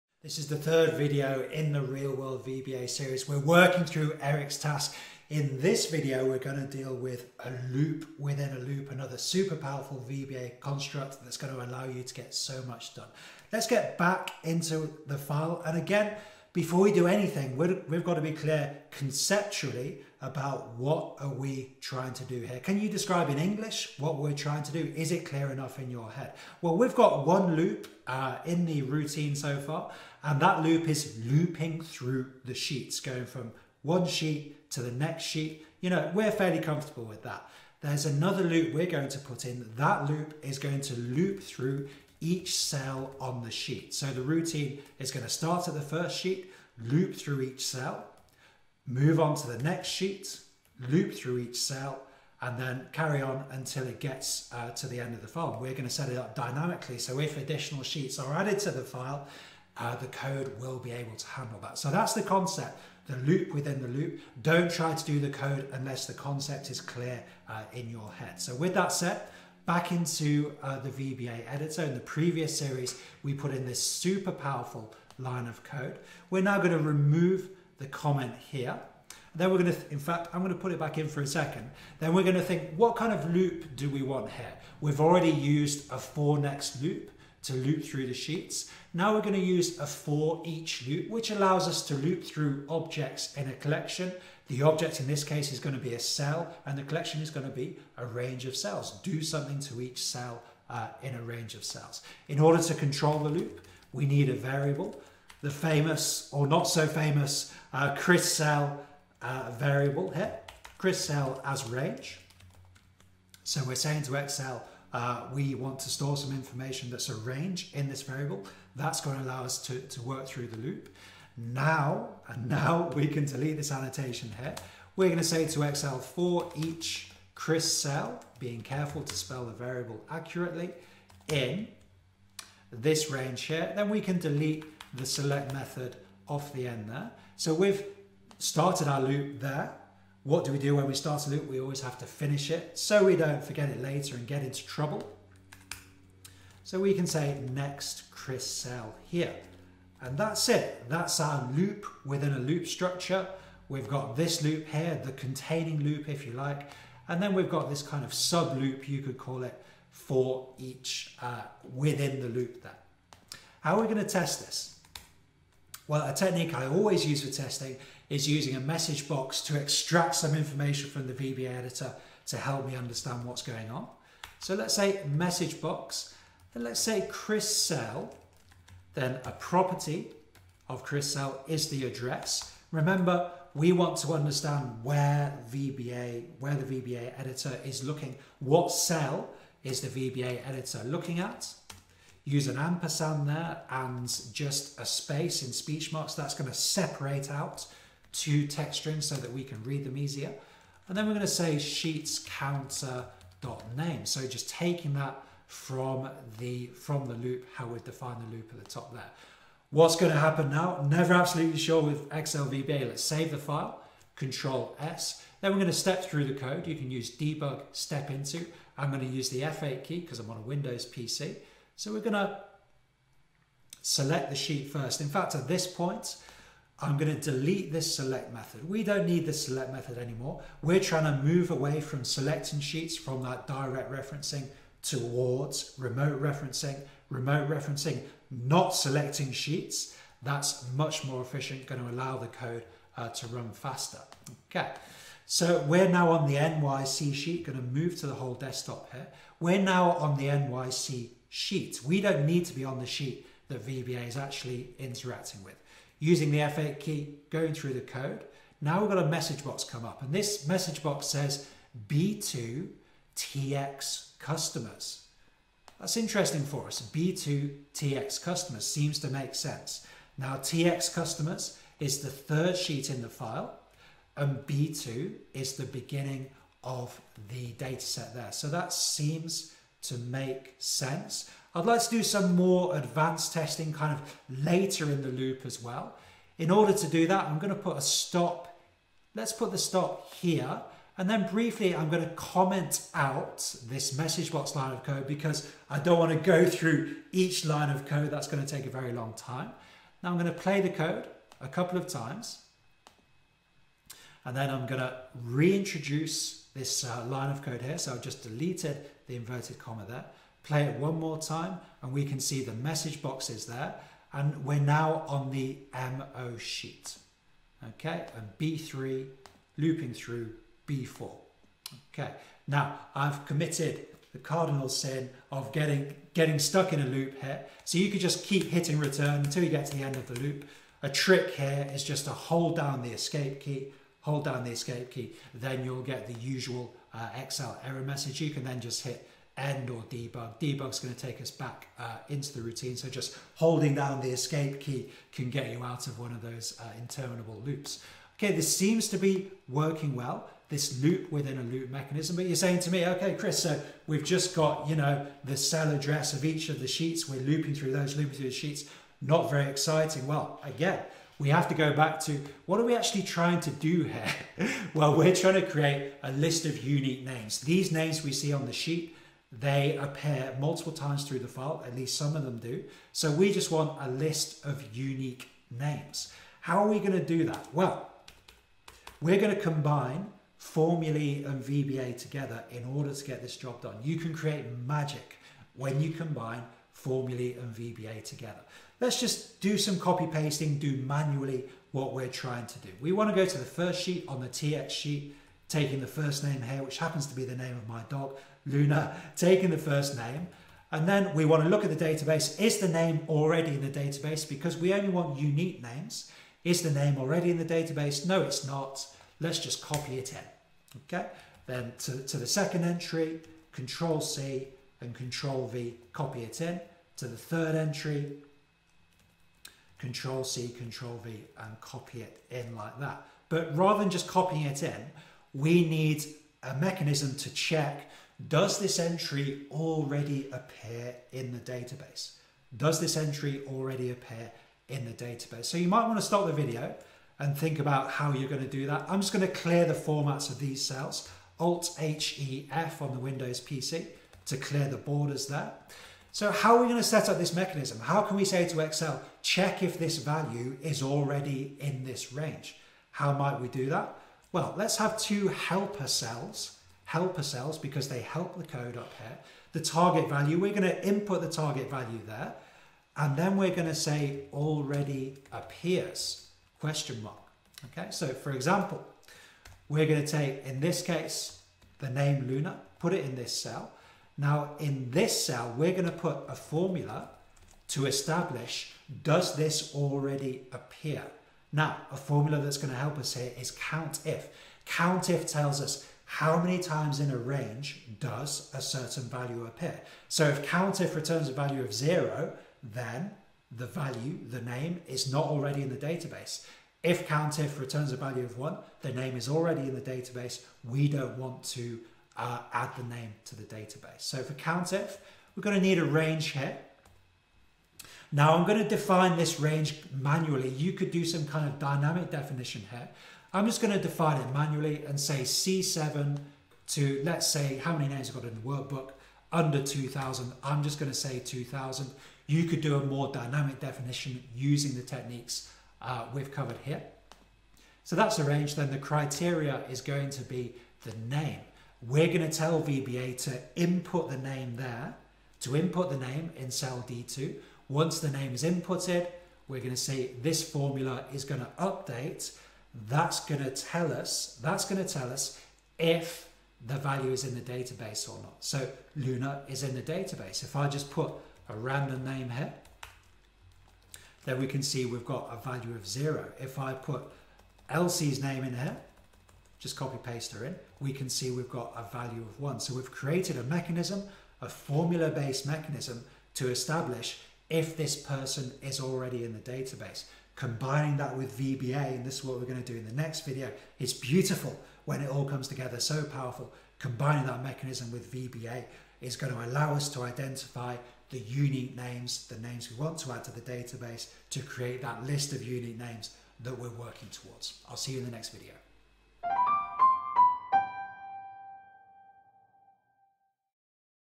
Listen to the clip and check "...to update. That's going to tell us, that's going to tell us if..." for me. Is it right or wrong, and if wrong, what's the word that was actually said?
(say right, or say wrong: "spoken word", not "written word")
right.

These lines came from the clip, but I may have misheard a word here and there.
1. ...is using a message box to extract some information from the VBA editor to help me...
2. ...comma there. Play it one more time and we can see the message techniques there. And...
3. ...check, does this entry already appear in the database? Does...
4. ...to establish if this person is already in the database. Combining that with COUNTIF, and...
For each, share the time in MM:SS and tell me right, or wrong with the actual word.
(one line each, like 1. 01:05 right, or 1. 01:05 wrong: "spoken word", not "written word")
1. 02:48 right
2. 05:09 wrong: "boxes", not "techniques"
3. 07:07 right
4. 09:26 wrong: "VBA", not "COUNTIF".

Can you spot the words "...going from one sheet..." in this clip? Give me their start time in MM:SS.
00:32.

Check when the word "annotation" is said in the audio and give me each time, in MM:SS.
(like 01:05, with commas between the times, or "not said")
02:03.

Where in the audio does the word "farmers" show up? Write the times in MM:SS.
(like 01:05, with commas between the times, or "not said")
not said.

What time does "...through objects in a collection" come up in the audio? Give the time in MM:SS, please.
01:32.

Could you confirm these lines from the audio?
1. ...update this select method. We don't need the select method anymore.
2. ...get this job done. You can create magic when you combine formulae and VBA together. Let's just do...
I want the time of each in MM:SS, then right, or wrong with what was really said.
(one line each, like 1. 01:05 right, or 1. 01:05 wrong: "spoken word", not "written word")
1. 03:47 wrong: "delete", not "update"
2. 06:23 right.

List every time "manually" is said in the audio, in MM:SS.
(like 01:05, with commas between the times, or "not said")
06:30, 08:29, 08:34.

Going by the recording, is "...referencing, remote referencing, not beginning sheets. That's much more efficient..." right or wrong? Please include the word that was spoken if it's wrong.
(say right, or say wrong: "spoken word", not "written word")
wrong: "selecting", not "beginning".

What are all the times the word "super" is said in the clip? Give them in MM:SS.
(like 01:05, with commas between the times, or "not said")
00:09, 01:13.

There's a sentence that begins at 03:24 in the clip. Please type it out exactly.
So just taking that from the from the loop, how we define the loop at the top there.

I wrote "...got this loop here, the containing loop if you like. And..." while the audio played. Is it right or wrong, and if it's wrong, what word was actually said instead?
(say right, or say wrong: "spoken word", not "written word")
right.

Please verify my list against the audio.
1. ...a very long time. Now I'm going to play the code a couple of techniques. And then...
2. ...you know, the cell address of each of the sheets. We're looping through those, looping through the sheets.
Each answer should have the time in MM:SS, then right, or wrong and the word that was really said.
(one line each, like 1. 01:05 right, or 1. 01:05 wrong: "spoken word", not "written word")
1. 04:58 wrong: "times", not "techniques"
2. 05:54 right.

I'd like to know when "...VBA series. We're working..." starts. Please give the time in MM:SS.
00:02.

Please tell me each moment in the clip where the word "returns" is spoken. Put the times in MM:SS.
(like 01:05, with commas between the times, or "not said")
05:28, 08:10, 08:17.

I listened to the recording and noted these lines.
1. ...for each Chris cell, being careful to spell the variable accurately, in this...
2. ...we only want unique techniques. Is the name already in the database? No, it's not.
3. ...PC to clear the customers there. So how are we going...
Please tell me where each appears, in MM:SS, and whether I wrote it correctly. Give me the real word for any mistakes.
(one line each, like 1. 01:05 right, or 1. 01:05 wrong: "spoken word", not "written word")
1. 02:05 right
2. 06:44 wrong: "names", not "techniques"
3. 07:23 wrong: "borders", not "customers".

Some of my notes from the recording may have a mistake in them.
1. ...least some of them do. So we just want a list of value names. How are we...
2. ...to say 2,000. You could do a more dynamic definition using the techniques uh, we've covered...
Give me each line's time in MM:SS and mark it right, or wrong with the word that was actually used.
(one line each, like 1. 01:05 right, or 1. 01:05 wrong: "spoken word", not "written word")
1. 06:11 wrong: "unique", not "value"
2. 08:40 right.